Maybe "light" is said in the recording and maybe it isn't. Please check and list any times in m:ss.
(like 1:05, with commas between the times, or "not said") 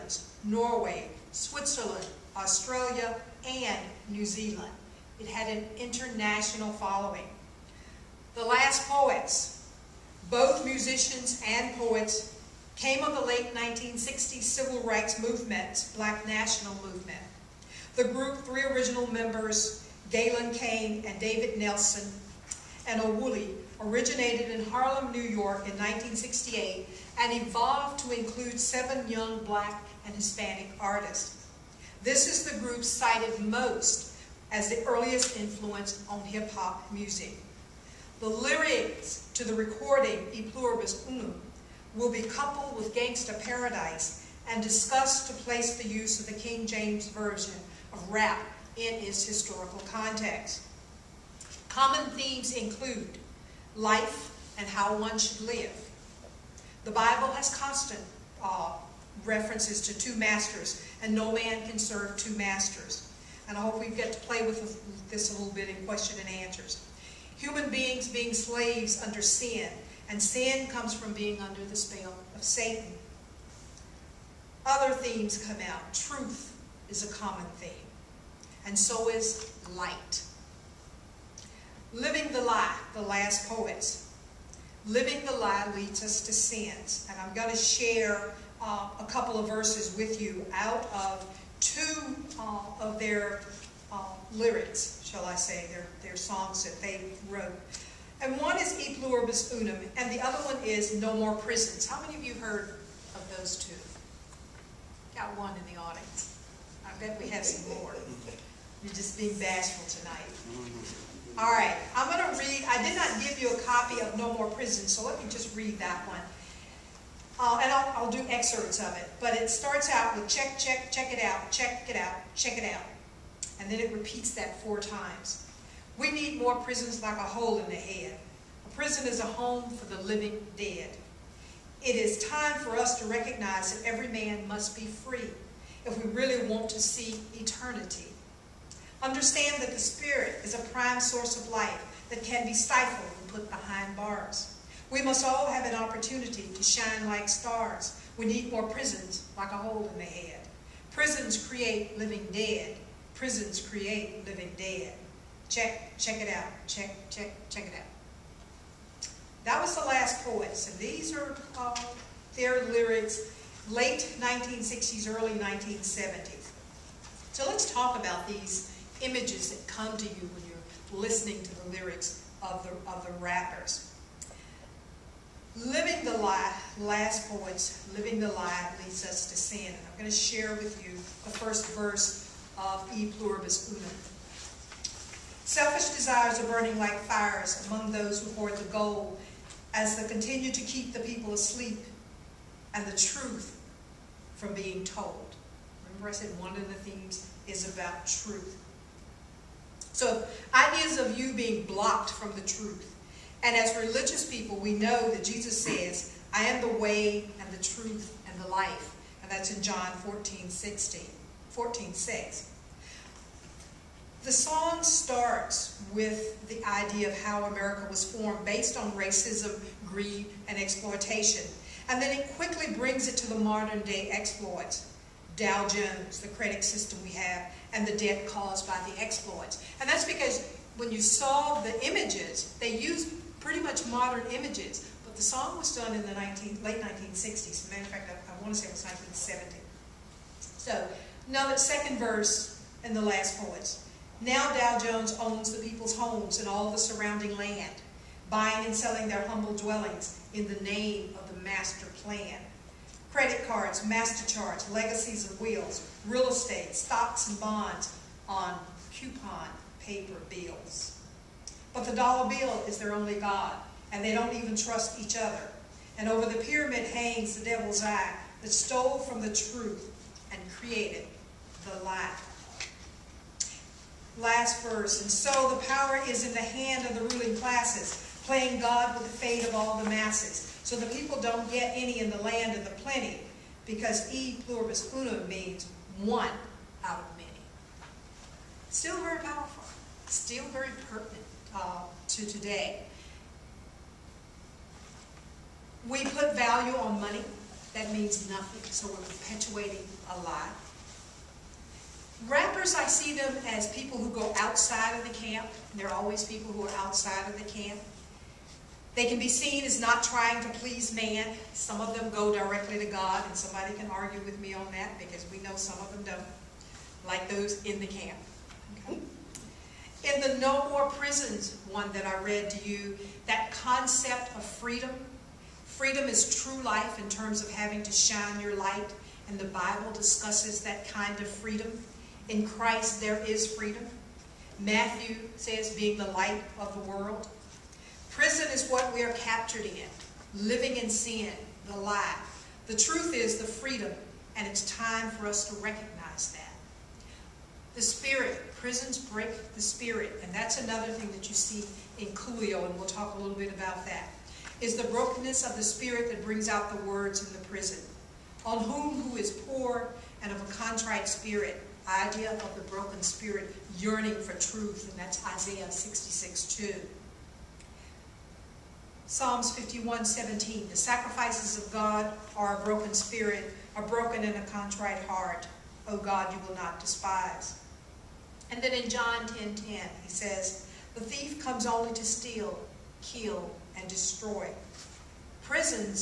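1:19, 4:31, 5:28, 5:36.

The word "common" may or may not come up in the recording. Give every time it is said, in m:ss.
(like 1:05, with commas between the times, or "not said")
0:51, 1:17.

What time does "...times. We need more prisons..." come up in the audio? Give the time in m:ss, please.
2:04.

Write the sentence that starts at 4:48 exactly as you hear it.
Still very powerful, still very pertinent uh, to today.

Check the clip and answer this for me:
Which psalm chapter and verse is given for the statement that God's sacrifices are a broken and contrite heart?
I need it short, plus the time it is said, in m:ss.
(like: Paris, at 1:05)
Psalms 51:17, at 6:09.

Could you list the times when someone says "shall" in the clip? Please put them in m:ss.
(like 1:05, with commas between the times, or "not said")
1:35.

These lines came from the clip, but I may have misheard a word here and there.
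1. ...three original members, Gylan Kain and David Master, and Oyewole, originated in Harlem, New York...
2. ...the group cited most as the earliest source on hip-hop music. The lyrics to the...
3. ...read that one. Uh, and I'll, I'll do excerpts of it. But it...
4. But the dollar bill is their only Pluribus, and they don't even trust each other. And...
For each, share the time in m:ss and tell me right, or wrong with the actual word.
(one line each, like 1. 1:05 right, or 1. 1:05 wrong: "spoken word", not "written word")
1. 0:18 wrong: "Nelson", not "Master"
2. 0:32 wrong: "influence", not "source"
3. 1:55 right
4. 4:21 wrong: "God", not "Pluribus".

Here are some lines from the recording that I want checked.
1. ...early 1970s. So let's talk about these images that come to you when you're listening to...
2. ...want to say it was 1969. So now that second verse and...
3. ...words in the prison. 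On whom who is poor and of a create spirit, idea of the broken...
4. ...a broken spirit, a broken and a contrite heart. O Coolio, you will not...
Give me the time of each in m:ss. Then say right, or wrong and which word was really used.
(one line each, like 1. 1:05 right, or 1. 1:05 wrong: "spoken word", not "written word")
1. 2:45 right
2. 3:58 wrong: "1970", not "1969"
3. 5:56 wrong: "contrite", not "create"
4. 6:12 wrong: "God", not "Coolio".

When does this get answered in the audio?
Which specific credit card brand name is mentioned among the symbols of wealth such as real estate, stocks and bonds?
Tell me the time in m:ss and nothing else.
4:13.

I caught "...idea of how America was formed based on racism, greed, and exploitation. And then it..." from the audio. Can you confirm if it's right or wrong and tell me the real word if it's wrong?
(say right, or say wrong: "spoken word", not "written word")
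right.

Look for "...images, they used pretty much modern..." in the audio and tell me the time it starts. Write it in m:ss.
3:51.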